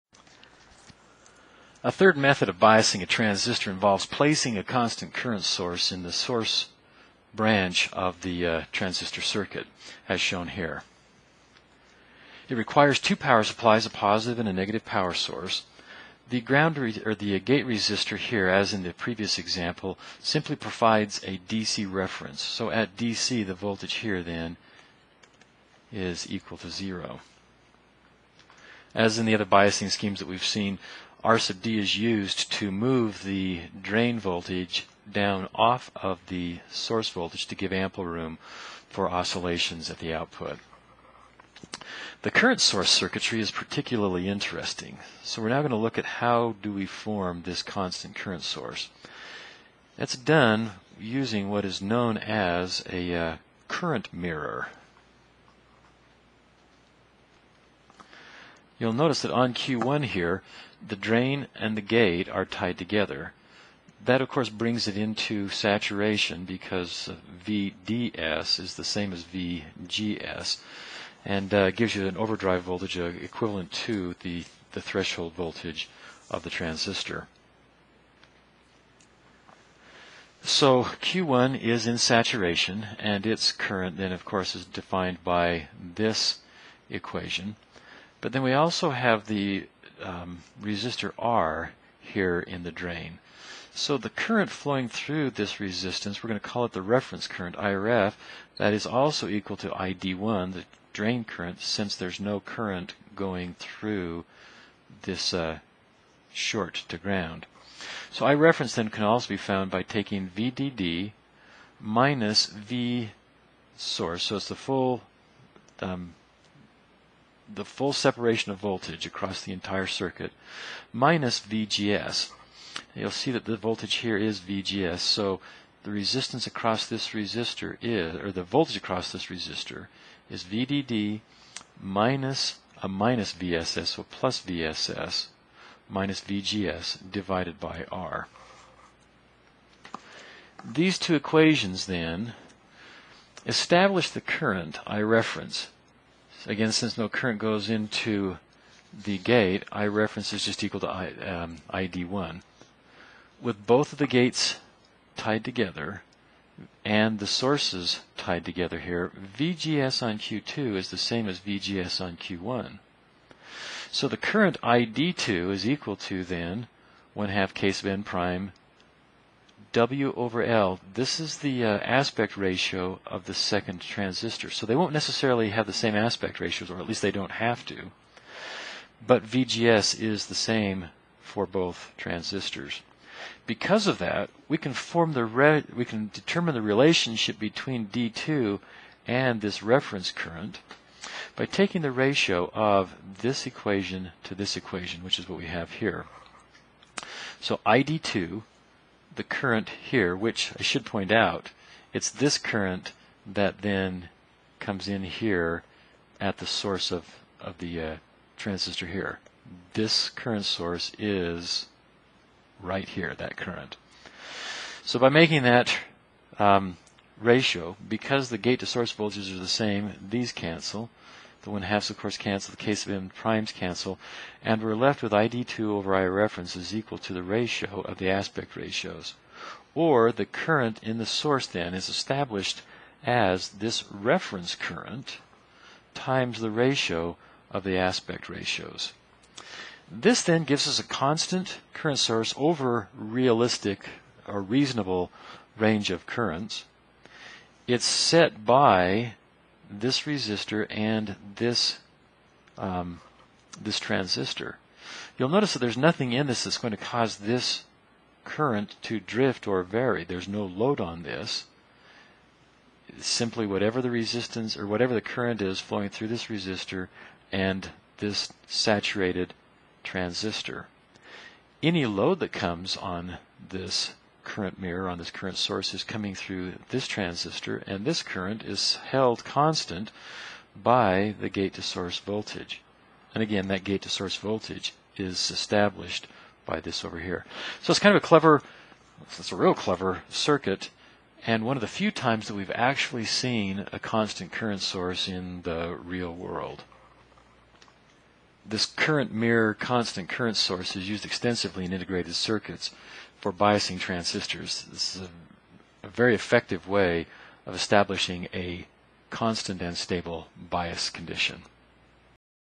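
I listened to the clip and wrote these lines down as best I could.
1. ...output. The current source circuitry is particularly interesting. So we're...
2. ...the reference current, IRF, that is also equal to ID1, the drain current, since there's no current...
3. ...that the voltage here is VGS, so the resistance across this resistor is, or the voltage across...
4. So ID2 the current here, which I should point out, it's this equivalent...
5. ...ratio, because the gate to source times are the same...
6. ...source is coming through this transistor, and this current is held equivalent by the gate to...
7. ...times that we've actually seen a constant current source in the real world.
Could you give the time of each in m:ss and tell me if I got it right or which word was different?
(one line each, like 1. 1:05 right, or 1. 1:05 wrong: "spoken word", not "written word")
1. 0:40 right
2. 1:36 right
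3. 2:03 right
4. 3:17 wrong: "current", not "equivalent"
5. 3:37 wrong: "voltages", not "times"
6. 4:35 wrong: "constant", not "equivalent"
7. 4:51 right.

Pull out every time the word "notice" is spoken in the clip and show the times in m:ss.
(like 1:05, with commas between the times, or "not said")
0:58, 4:15.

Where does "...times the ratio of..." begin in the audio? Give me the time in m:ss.
3:55.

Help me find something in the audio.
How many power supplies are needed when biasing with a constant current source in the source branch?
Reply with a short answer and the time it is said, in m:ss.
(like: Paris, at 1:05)
2, at 0:12.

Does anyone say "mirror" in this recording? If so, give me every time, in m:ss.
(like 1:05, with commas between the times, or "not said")
0:54, 4:34, 4:59.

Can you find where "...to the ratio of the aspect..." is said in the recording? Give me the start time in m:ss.
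3:46.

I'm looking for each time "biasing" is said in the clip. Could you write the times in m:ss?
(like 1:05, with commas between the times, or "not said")
0:02, 0:29, 5:03.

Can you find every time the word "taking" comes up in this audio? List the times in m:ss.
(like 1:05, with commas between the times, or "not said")
1:49, 3:11.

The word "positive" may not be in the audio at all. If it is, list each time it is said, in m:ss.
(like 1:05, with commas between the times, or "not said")
0:13.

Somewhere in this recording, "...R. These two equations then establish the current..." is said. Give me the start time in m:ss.
2:17.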